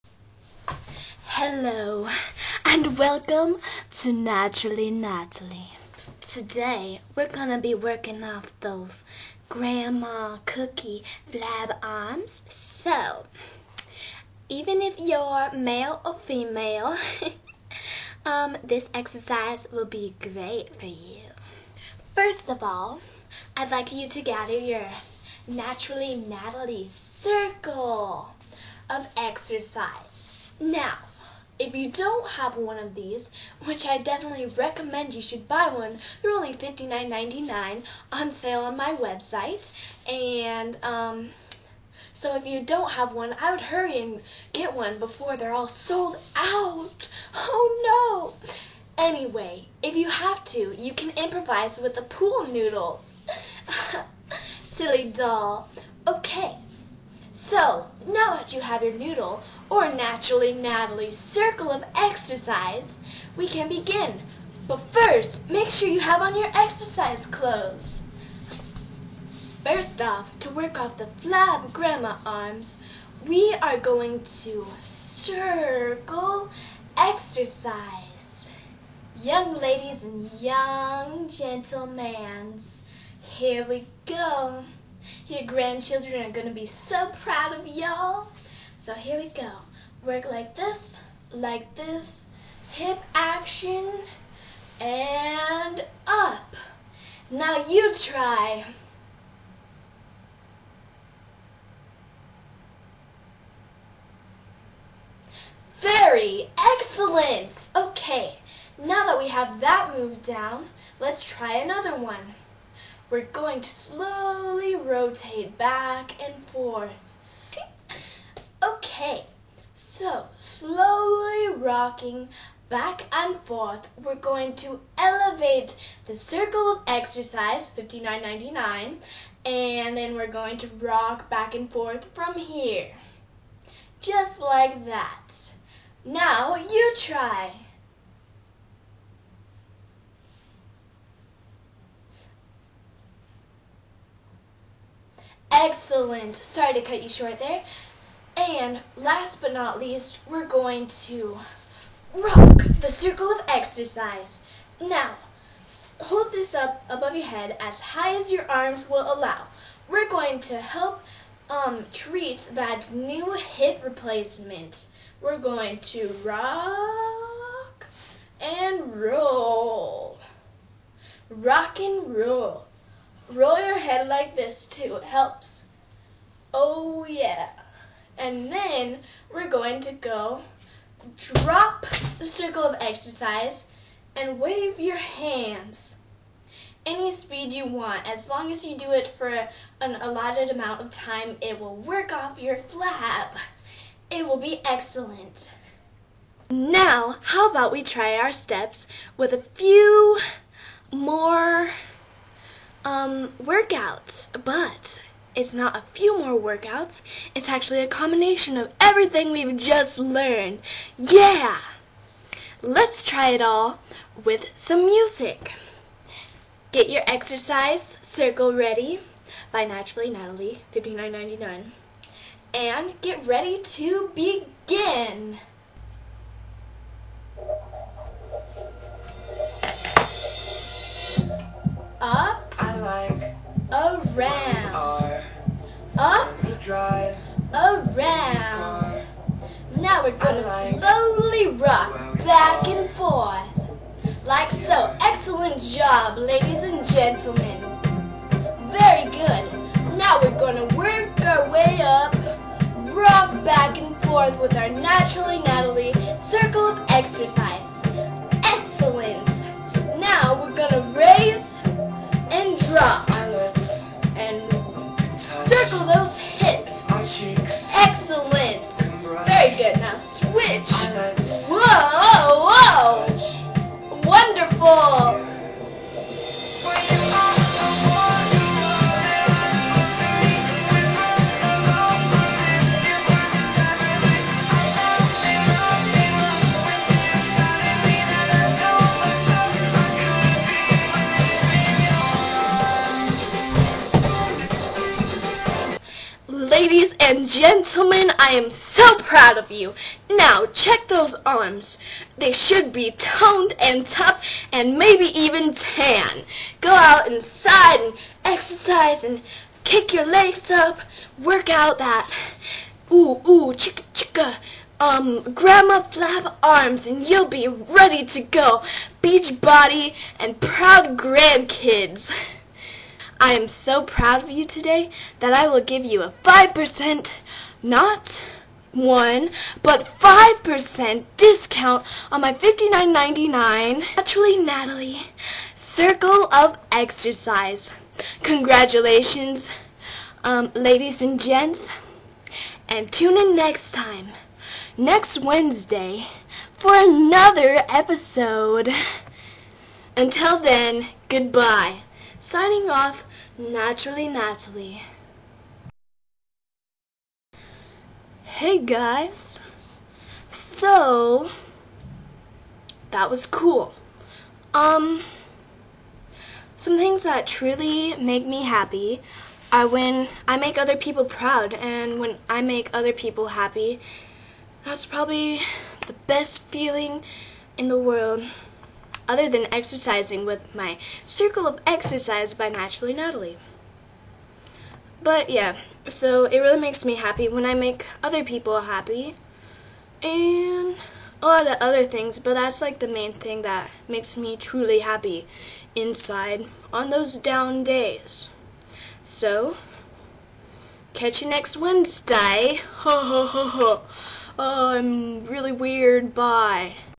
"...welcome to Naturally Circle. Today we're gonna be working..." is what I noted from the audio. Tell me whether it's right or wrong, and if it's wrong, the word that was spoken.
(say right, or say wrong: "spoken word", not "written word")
wrong: "Natalie", not "Circle".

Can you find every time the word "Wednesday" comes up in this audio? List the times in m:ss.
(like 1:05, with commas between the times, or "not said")
5:45, 6:41.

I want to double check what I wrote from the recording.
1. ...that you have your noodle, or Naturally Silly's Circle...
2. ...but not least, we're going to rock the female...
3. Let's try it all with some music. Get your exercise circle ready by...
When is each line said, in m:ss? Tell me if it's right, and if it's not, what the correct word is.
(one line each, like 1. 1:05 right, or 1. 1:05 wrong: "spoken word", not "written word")
1. 0:58 wrong: "Natalie", not "Silly"
2. 2:29 wrong: "circle", not "female"
3. 3:32 right.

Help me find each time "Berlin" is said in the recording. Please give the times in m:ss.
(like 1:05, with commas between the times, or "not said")
not said.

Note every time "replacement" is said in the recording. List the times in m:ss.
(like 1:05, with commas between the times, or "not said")
2:43.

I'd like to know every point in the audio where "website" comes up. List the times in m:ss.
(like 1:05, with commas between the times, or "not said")
0:38.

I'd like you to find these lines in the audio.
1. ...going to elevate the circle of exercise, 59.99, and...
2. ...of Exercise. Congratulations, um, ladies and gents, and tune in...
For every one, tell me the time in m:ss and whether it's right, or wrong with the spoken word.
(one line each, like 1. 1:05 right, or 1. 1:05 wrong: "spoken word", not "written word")
1. 2:04 right
2. 5:36 right.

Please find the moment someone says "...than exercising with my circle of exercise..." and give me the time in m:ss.
6:19.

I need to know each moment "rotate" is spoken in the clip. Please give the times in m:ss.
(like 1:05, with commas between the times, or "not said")
1:54.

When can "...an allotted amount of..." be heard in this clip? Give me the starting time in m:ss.
3:09.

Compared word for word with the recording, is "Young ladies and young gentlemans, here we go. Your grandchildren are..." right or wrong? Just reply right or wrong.
right.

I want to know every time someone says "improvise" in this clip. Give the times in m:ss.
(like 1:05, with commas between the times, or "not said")
0:51.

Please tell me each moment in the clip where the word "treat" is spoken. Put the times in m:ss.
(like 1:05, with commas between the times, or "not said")
2:41.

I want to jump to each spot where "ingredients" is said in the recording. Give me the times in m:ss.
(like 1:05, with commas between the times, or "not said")
not said.